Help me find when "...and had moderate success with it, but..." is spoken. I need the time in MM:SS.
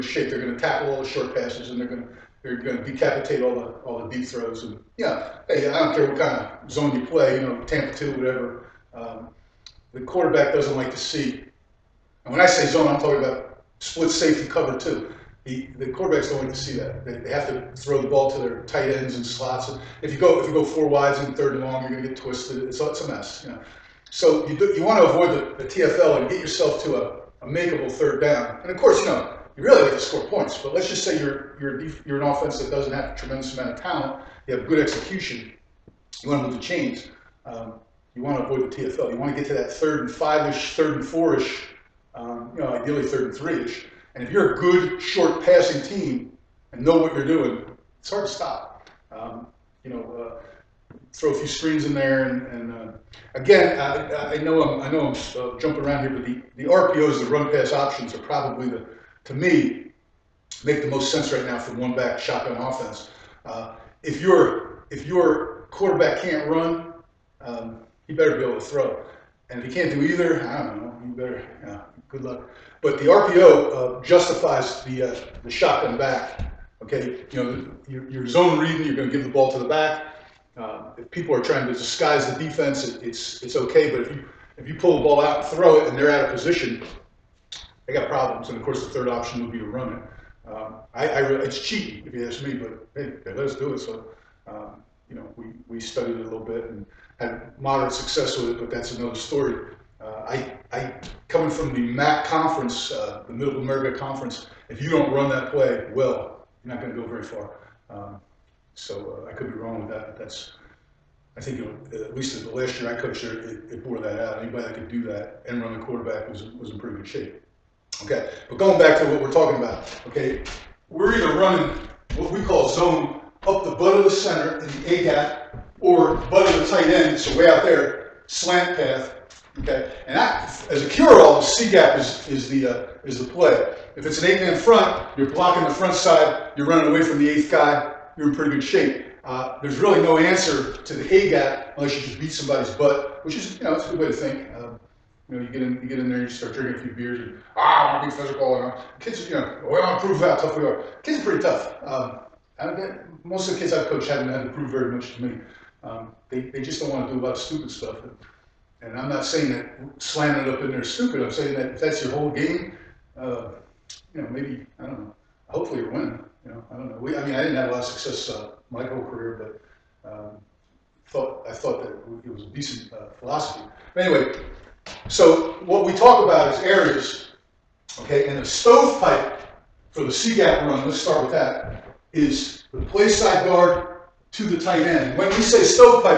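01:36.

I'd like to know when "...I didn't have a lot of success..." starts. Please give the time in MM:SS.
02:47.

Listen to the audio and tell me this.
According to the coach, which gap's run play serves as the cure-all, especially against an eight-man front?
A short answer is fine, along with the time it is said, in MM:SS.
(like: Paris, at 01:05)
C gap, at 02:11.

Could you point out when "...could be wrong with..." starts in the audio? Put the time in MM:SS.
01:49.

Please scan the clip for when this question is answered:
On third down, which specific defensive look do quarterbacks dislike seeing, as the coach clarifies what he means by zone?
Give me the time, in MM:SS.
00:13.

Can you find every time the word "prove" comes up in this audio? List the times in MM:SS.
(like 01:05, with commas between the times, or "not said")
02:30, 02:34.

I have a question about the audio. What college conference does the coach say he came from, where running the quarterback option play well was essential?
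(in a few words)
Middle America conference.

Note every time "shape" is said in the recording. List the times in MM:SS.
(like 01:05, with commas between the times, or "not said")
00:00, 01:57, 02:18.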